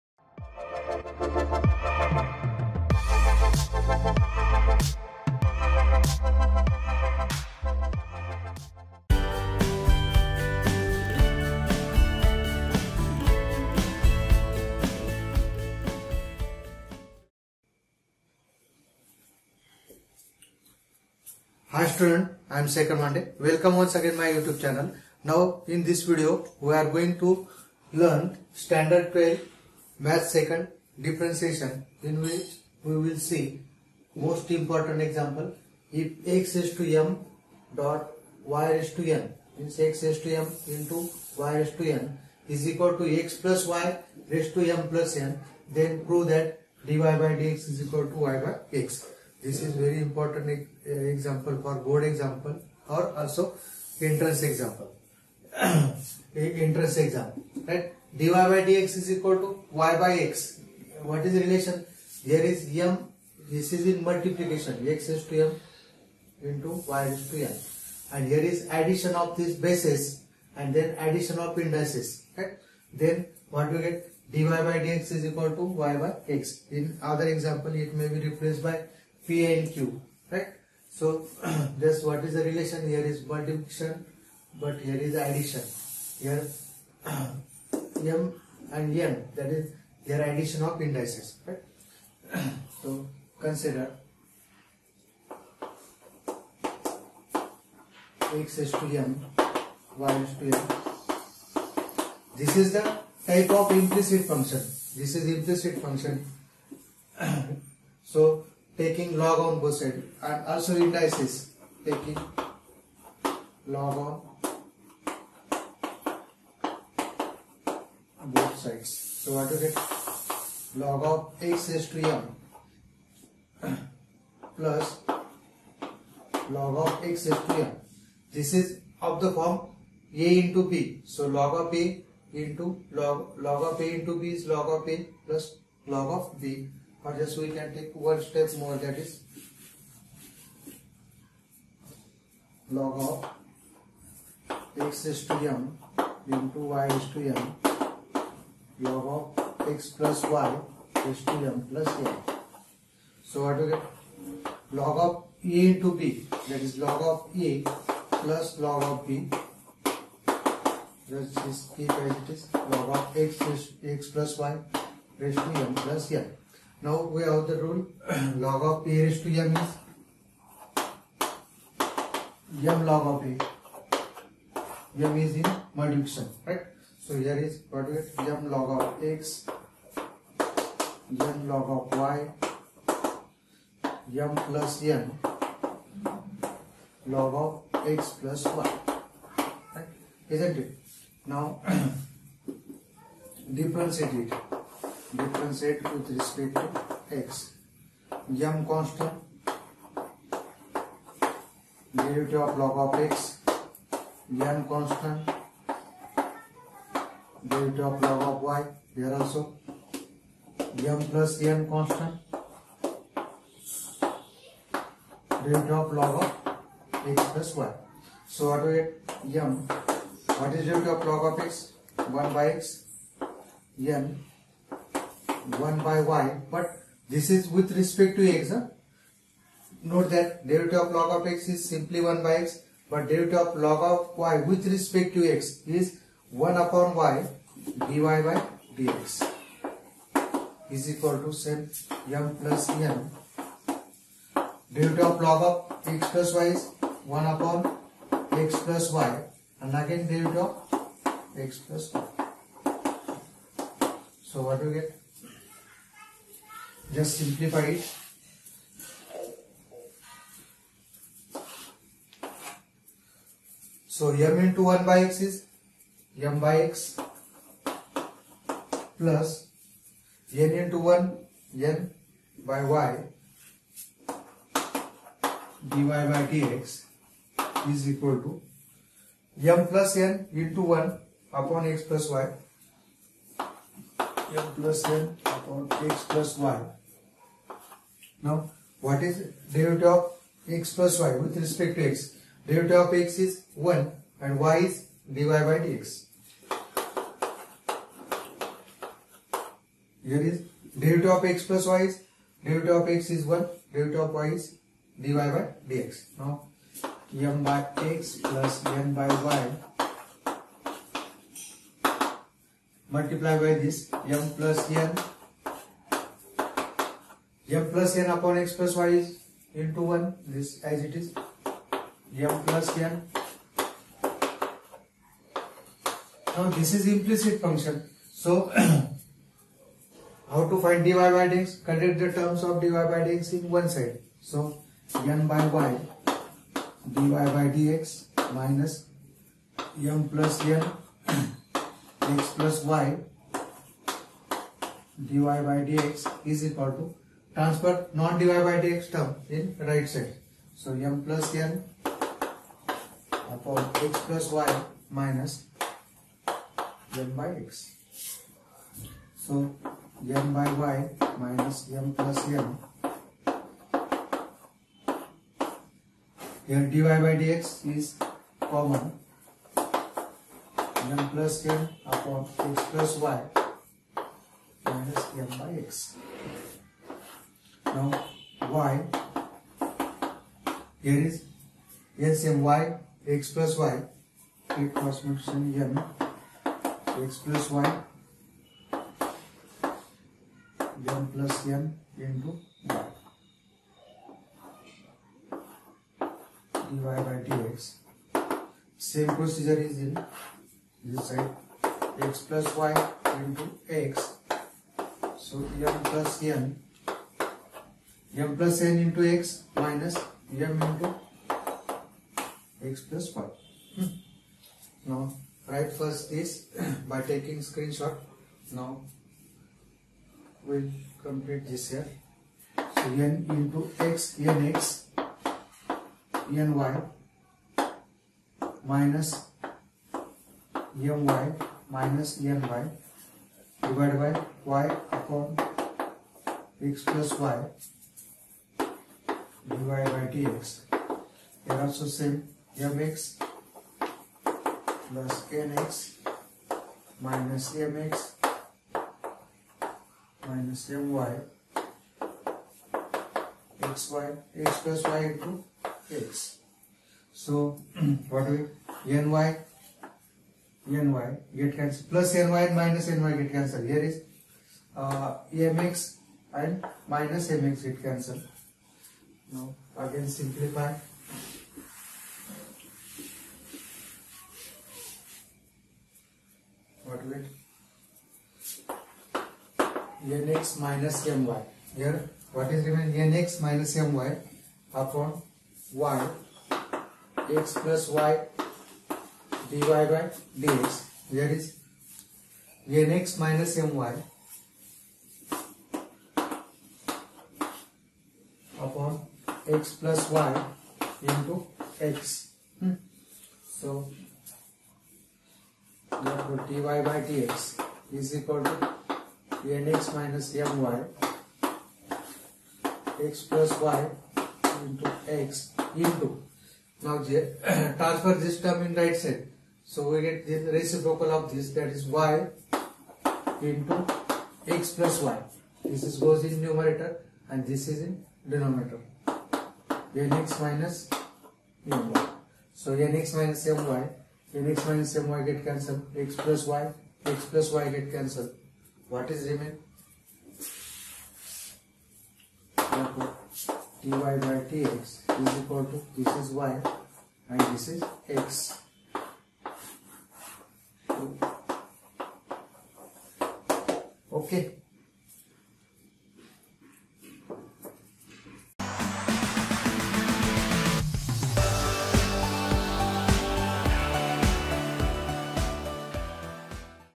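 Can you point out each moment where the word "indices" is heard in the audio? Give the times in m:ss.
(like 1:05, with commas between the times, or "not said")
1:11, 1:30, 1:50.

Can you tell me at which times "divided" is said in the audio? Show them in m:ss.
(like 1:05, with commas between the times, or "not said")
5:47, 7:13.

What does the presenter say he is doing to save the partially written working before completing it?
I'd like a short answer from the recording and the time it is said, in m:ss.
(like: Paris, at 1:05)
taking screenshot, at 6:57.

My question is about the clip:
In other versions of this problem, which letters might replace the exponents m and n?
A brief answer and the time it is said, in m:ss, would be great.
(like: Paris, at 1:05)
P and Q, at 1:19.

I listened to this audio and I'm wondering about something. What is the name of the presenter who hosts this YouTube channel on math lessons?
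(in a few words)
Shekhar Mande.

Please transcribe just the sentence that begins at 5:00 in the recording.
Here is derivative of x plus y is derivative of x is 1, derivative of y is dy by dx.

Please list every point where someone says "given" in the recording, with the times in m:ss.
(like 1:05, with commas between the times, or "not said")
8:02.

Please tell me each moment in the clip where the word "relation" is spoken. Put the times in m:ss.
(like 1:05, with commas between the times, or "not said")
1:01, 1:22.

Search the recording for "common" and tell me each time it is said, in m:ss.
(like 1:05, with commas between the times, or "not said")
6:08.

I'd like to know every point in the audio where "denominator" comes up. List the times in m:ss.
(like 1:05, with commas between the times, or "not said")
8:48.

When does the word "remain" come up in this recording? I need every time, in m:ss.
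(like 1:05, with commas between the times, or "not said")
8:59.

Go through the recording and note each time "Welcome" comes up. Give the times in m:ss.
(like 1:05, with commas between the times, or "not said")
0:23.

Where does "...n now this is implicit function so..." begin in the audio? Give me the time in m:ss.
5:22.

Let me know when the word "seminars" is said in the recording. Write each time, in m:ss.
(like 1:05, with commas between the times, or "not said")
not said.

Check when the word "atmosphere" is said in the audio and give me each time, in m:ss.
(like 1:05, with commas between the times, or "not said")
not said.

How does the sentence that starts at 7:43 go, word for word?
Here is uh, mx and minus mx get cancelled.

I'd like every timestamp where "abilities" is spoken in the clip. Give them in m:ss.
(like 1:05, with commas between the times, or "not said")
not said.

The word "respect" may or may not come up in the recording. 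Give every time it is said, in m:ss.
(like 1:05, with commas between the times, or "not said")
3:16, 3:47, 3:54, 4:51.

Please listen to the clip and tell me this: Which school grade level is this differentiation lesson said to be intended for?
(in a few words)
Standard 12.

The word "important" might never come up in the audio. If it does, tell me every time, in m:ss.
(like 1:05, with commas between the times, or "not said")
0:34, 0:49.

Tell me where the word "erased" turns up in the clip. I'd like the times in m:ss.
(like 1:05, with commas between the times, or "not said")
not said.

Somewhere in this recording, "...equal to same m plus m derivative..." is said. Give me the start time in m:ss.
4:00.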